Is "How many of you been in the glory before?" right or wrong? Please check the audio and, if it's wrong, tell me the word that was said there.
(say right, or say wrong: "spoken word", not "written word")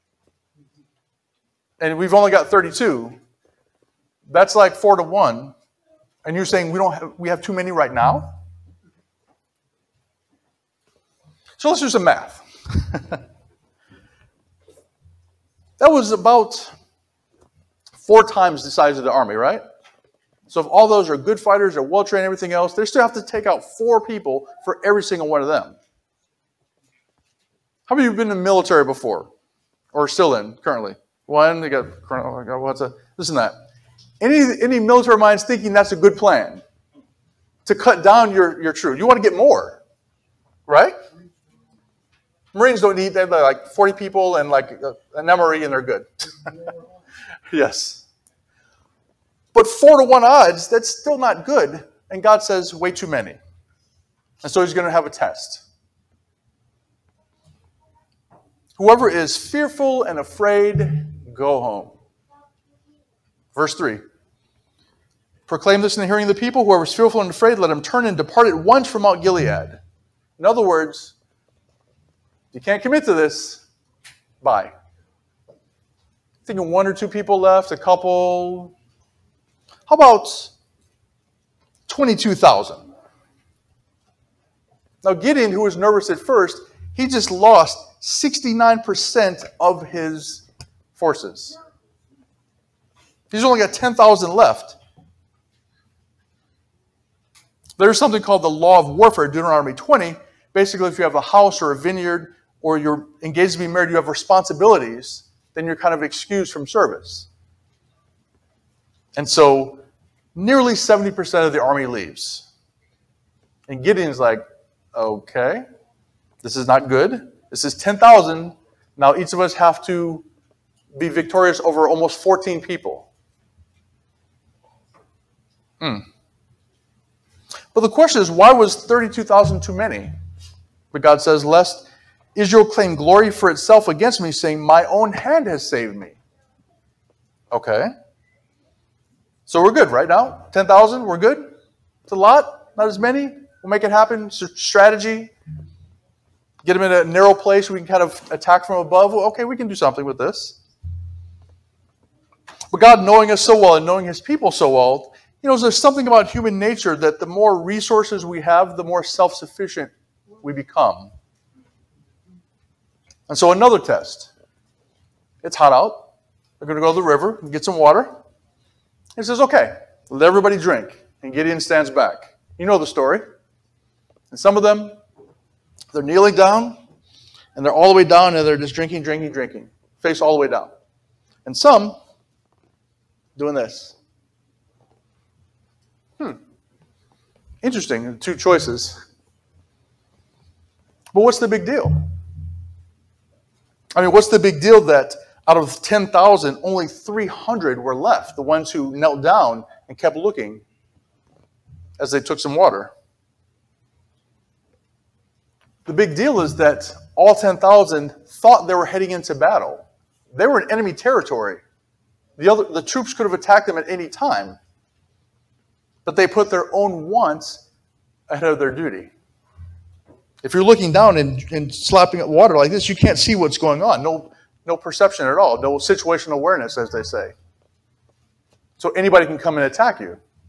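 wrong: "military", not "glory".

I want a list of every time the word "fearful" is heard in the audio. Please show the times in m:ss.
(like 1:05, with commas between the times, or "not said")
0:59, 1:06.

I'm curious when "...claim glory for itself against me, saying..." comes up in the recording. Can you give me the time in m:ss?
2:12.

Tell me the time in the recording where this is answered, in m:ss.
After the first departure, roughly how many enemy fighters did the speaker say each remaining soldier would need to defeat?
2:01.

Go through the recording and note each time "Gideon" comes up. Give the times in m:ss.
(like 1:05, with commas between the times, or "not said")
1:25, 1:53, 2:51.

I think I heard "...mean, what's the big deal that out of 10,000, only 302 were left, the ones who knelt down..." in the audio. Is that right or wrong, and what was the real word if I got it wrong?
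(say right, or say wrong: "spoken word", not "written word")
wrong: "300", not "302".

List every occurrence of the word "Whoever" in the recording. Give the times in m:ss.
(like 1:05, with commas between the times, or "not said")
0:58, 1:06.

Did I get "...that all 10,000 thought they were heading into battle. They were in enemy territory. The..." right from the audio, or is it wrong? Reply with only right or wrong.
right.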